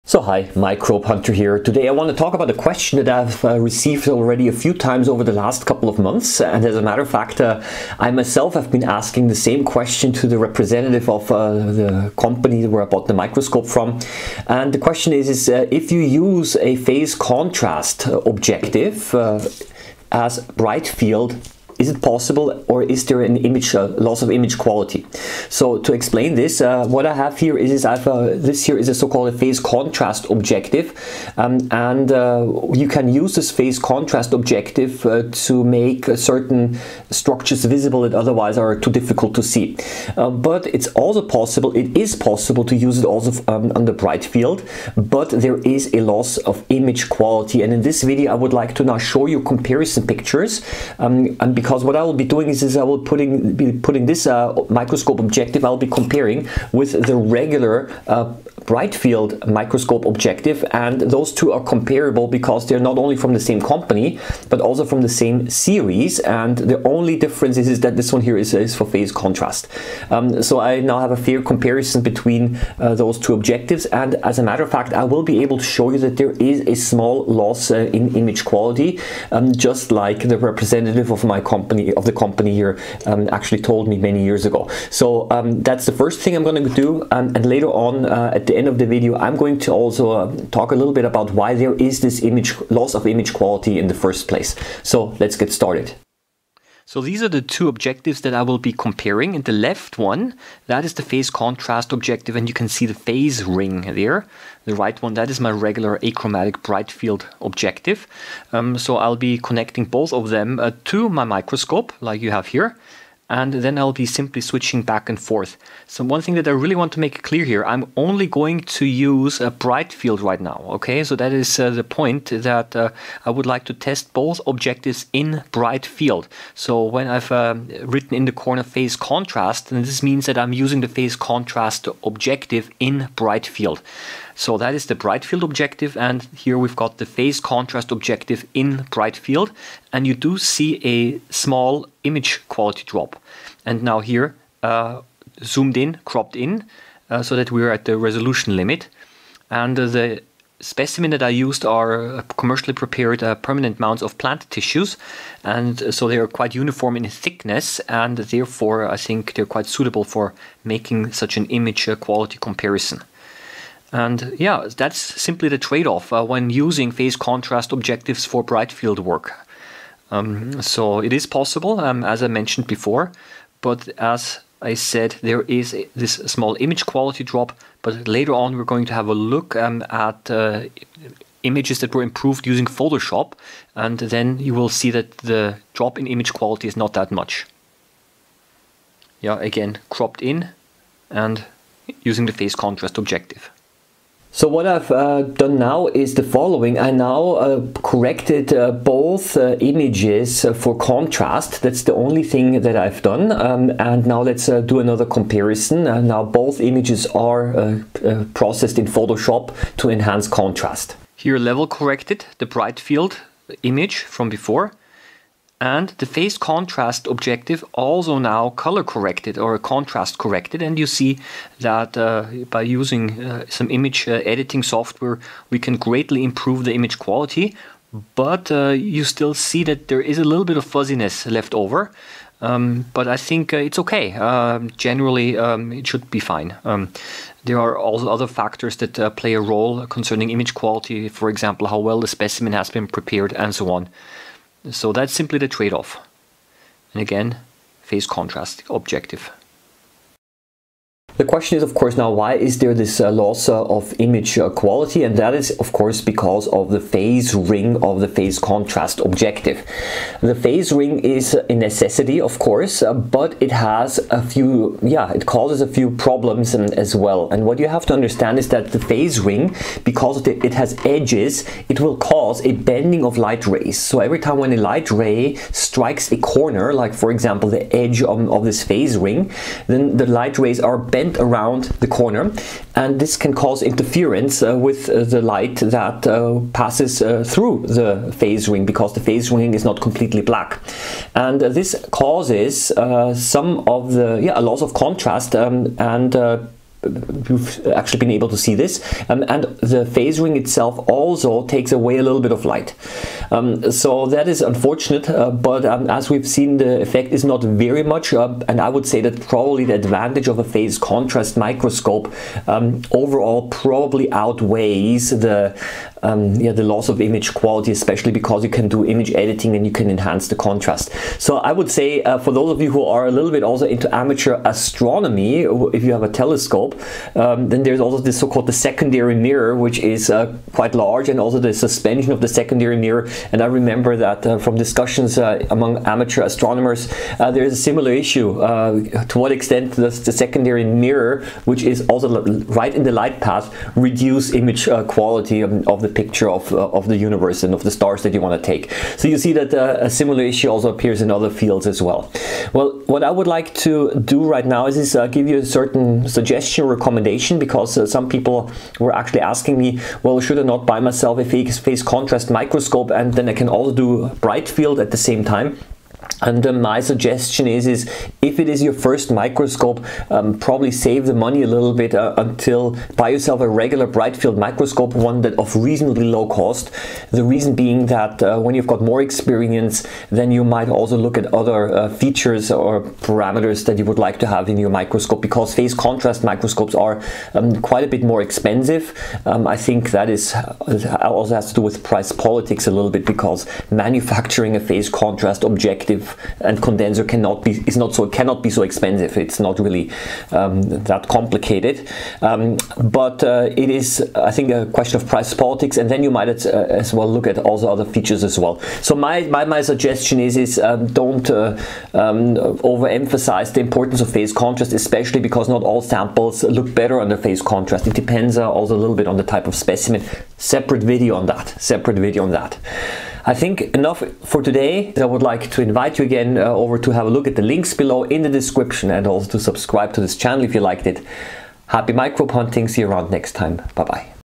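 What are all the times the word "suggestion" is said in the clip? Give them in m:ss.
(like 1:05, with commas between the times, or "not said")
5:56, 6:06, 6:49.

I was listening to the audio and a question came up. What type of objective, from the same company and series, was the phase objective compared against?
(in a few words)
Achromatic bright field objective.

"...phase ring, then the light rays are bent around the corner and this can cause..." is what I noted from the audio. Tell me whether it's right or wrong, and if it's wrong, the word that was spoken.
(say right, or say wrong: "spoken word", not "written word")
right.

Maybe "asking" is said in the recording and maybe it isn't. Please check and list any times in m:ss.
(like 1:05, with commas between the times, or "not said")
0:08, 5:59.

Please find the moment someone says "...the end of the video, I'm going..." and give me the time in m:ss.
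1:28.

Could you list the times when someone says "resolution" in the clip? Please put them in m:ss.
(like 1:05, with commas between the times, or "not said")
2:27.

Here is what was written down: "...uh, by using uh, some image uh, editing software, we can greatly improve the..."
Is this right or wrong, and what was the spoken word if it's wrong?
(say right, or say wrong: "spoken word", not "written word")
right.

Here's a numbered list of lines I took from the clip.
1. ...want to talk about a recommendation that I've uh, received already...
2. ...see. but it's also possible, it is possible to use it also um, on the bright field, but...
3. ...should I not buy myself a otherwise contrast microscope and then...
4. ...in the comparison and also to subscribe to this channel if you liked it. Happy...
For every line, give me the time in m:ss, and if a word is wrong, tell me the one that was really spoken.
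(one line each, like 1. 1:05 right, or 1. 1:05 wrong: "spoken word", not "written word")
1. 0:01 wrong: "question", not "recommendation"
2. 0:39 right
3. 6:00 wrong: "phase", not "otherwise"
4. 7:08 wrong: "description", not "comparison".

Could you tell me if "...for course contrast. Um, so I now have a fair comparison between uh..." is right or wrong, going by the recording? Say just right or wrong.
wrong.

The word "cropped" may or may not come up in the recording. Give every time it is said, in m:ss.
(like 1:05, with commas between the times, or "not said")
2:26, 3:09.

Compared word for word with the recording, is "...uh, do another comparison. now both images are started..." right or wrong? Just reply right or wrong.
wrong.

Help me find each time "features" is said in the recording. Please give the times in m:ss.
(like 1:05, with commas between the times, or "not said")
6:21, 6:47.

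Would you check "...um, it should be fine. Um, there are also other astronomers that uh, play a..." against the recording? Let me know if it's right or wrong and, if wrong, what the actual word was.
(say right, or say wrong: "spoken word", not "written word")
wrong: "factors", not "astronomers".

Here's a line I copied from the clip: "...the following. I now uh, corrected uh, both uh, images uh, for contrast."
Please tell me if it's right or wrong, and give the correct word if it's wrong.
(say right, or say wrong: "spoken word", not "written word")
right.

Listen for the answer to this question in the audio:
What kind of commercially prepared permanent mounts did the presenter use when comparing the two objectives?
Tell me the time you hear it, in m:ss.
2:34.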